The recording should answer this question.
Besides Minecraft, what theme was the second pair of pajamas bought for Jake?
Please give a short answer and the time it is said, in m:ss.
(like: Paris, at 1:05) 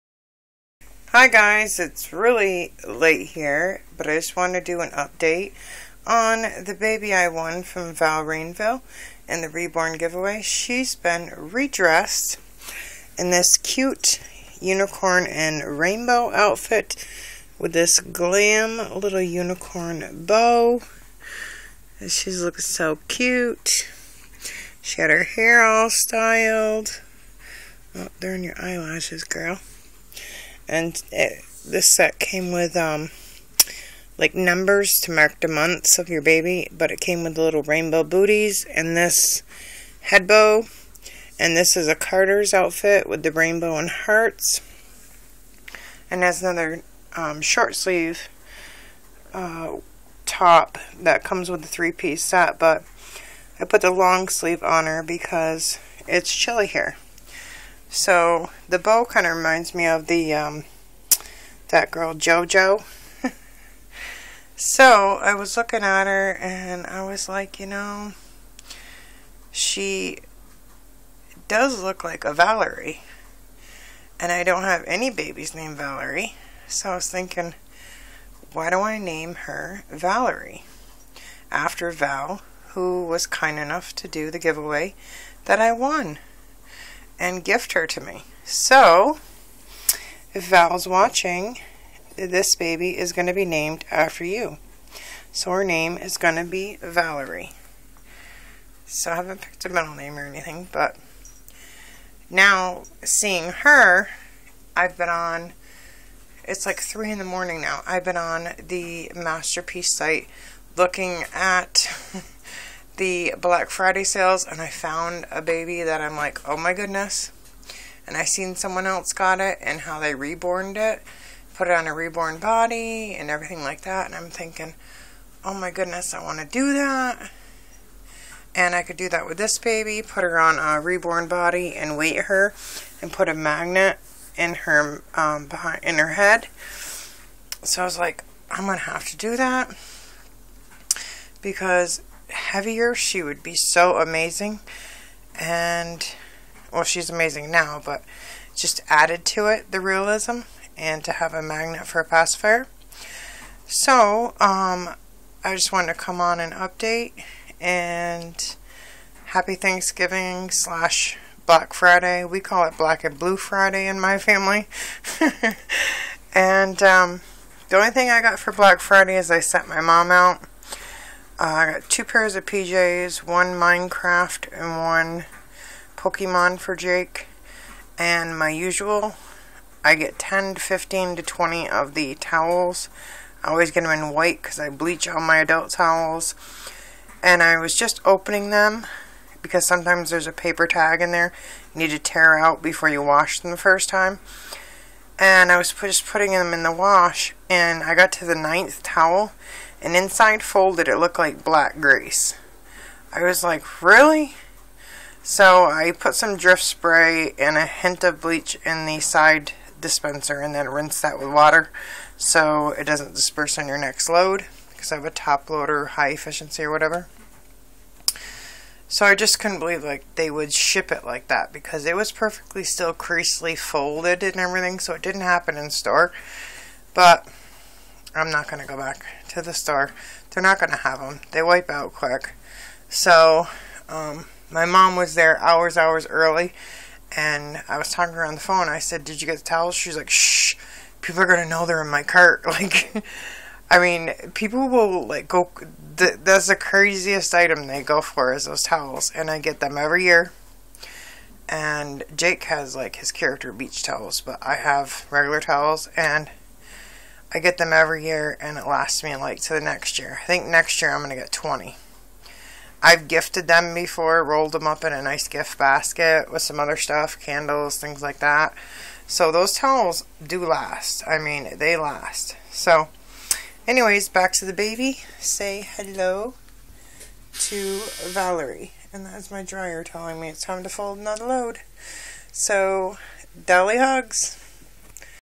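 Pokemon, at 2:55.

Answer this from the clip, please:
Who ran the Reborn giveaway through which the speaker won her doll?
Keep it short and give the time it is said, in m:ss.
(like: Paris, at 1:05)
Val Rainville, at 0:07.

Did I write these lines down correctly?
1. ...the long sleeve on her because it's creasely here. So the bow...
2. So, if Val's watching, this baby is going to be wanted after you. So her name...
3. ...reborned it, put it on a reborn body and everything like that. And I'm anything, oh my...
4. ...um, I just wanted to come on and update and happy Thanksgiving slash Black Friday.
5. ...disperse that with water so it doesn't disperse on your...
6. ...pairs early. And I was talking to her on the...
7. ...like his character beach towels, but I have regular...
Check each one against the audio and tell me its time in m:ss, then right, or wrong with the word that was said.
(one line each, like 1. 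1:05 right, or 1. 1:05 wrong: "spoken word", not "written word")
1. 0:53 wrong: "chilly", not "creasely"
2. 1:28 wrong: "named", not "wanted"
3. 2:00 wrong: "thinking", not "anything"
4. 2:34 right
5. 3:30 wrong: "rinse", not "disperse"
6. 3:55 wrong: "hours", not "pairs"
7. 4:12 right.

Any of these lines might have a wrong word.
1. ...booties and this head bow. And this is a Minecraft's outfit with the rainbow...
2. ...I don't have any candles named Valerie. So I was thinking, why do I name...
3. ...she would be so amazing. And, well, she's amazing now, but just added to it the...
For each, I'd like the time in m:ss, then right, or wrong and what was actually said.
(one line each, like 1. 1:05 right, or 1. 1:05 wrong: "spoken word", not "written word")
1. 0:38 wrong: "Carter", not "Minecraft"
2. 1:14 wrong: "babies", not "candles"
3. 2:22 right.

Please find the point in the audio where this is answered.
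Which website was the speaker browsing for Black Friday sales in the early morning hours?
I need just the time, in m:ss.
1:49.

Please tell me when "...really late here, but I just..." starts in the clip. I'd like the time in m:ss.
0:02.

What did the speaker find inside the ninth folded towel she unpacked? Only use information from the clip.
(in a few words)
black grease.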